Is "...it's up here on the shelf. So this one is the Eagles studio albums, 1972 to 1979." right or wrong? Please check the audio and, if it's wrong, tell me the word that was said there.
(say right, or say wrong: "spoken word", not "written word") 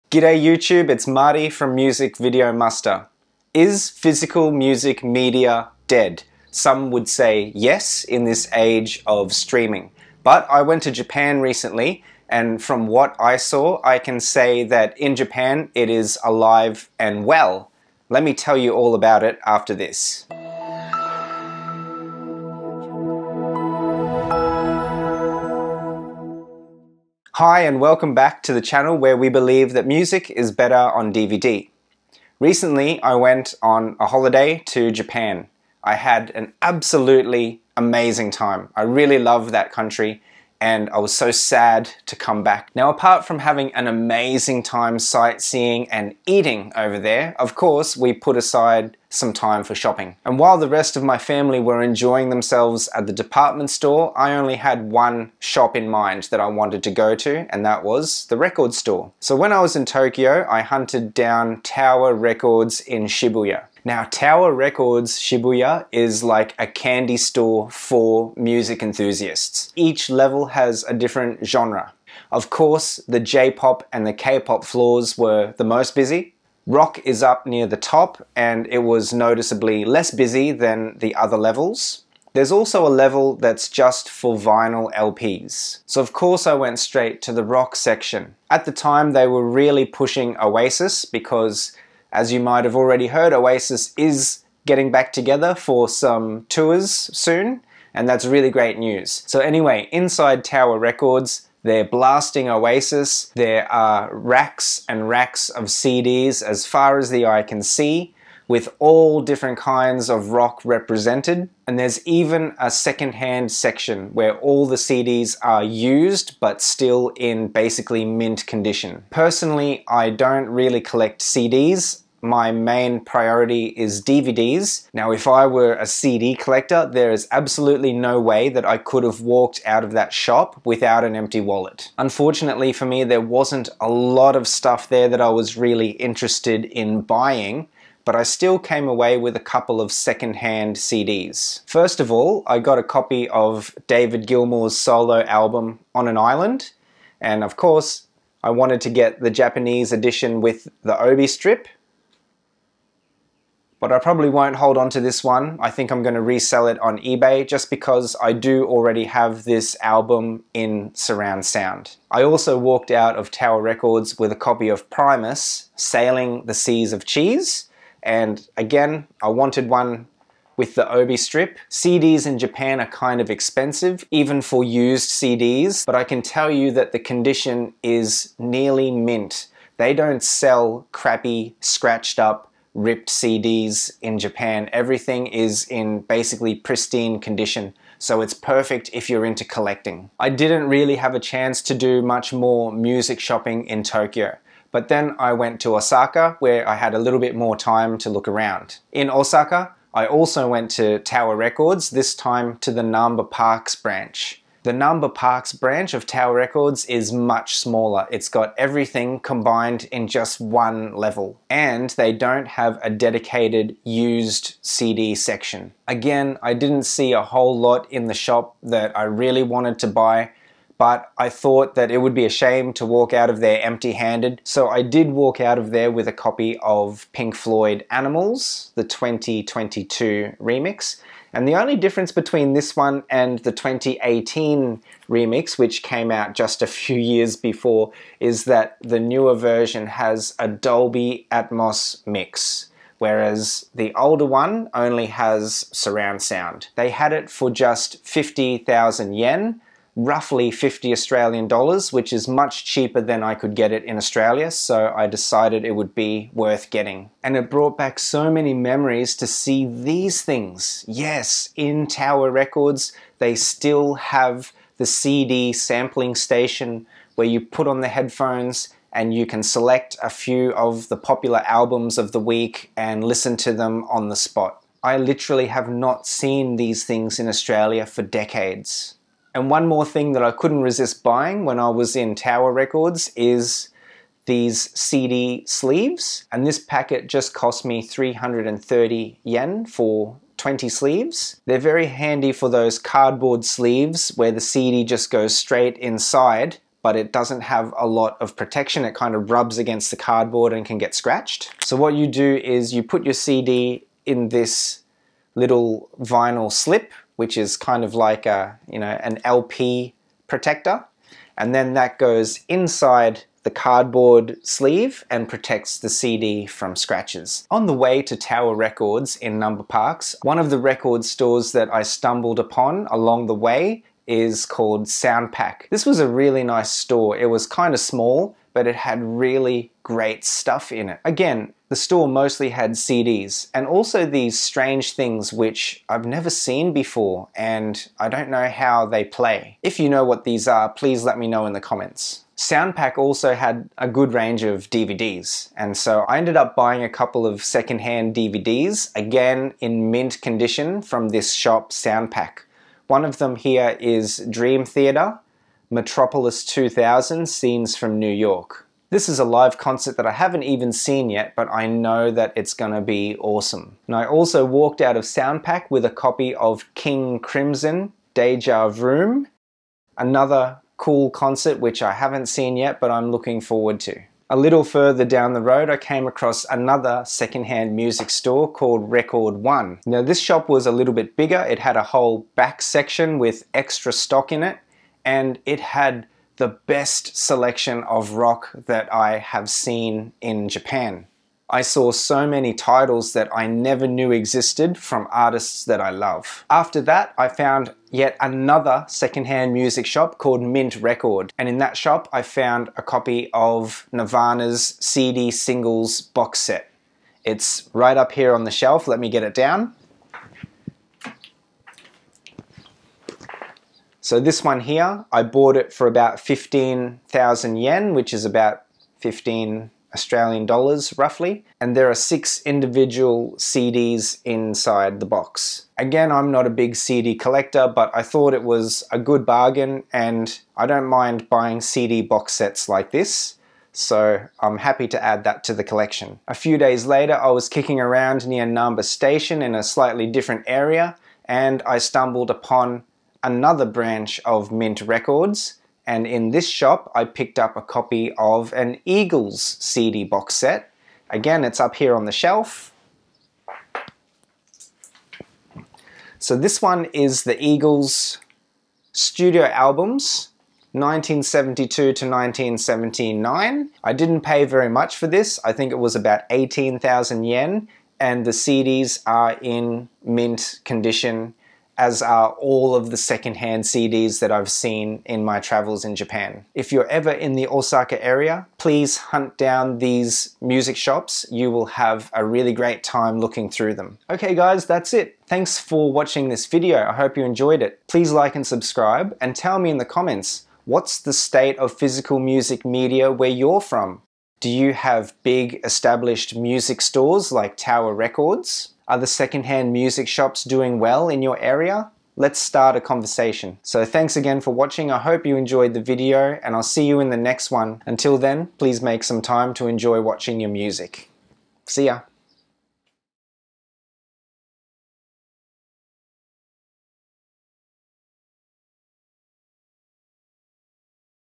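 right.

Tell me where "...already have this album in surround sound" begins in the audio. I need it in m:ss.
2:38.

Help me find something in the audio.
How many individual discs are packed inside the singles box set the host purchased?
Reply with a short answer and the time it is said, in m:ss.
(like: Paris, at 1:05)
6, at 7:01.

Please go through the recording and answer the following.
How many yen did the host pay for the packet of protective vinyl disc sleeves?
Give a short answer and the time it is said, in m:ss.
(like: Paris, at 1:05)
330 yen, at 4:47.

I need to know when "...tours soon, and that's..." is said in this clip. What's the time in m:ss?
1:36.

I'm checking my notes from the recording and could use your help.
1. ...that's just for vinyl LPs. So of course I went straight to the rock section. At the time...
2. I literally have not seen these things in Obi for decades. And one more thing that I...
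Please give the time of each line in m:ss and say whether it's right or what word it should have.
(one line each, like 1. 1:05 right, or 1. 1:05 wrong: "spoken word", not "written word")
1. 1:23 right
2. 4:34 wrong: "Australia", not "Obi".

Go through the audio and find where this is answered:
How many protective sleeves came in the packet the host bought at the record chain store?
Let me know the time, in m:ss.
4:50.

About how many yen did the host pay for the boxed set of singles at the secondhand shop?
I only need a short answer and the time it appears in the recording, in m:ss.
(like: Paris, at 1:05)
15,000 yen, at 6:56.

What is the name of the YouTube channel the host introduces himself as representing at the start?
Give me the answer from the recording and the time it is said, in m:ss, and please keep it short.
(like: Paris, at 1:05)
Music Video Muster, at 0:01.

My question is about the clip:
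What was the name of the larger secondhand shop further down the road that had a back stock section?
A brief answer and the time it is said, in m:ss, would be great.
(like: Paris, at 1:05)
Record One, at 6:18.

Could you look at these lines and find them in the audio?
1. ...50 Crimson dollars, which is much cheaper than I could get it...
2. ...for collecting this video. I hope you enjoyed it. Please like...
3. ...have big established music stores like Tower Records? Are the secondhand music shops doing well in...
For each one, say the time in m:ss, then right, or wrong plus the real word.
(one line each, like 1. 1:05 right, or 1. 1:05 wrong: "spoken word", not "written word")
1. 4:10 wrong: "Australian", not "Crimson"
2. 8:05 wrong: "watching", not "collecting"
3. 8:14 right.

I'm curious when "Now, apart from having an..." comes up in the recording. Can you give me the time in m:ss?
0:42.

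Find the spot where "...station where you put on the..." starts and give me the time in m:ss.
4:26.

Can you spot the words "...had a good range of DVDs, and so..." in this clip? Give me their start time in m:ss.
5:43.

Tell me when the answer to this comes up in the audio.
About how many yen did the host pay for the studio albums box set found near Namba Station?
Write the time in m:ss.
7:46.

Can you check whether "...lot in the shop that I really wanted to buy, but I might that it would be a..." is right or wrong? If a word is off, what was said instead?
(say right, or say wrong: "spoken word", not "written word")
wrong: "thought", not "might".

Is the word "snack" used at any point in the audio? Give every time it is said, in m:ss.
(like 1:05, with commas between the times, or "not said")
not said.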